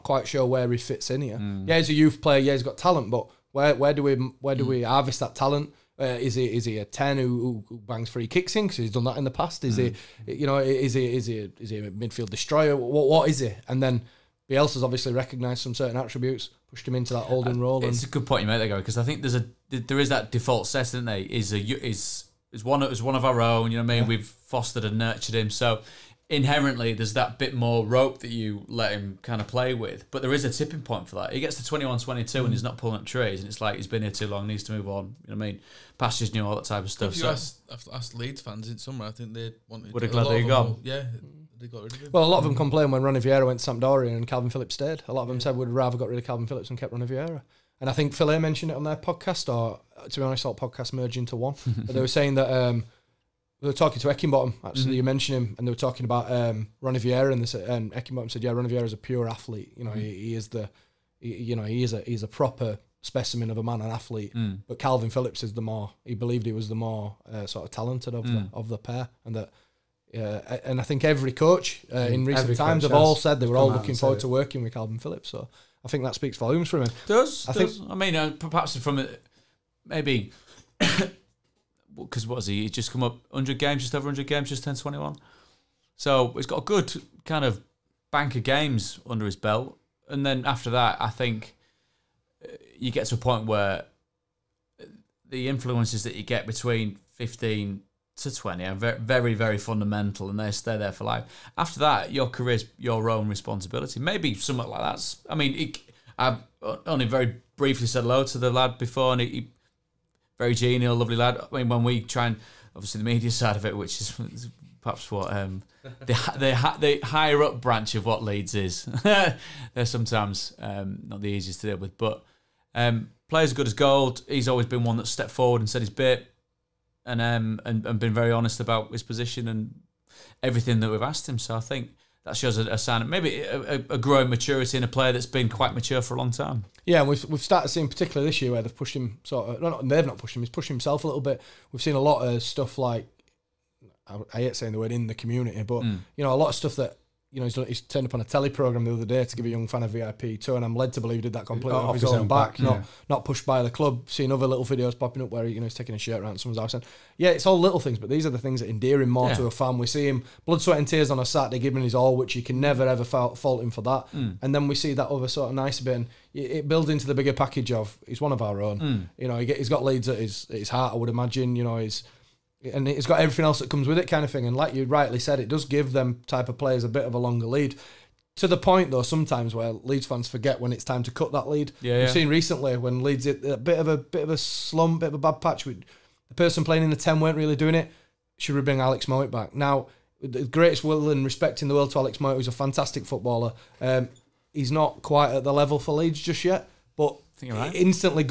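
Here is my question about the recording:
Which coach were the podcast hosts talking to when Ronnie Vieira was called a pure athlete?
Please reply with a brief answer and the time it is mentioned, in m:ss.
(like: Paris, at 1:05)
Heckingbottom, at 0:54.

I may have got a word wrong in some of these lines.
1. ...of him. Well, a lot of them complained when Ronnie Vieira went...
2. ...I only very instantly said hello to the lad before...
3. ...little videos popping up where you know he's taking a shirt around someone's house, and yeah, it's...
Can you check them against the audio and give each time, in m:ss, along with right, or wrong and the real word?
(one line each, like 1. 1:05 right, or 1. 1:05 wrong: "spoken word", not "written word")
1. 0:41 right
2. 1:46 wrong: "briefly", not "instantly"
3. 2:34 right.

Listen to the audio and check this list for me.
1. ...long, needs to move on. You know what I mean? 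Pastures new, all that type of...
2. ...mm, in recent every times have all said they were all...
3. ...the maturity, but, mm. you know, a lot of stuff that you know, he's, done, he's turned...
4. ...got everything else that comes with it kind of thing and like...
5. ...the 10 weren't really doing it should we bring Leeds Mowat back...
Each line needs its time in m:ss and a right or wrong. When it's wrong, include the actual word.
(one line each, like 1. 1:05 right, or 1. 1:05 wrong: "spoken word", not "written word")
1. 0:34 right
2. 1:11 right
3. 2:25 wrong: "community", not "maturity"
4. 2:53 right
5. 3:06 wrong: "Alex", not "Leeds".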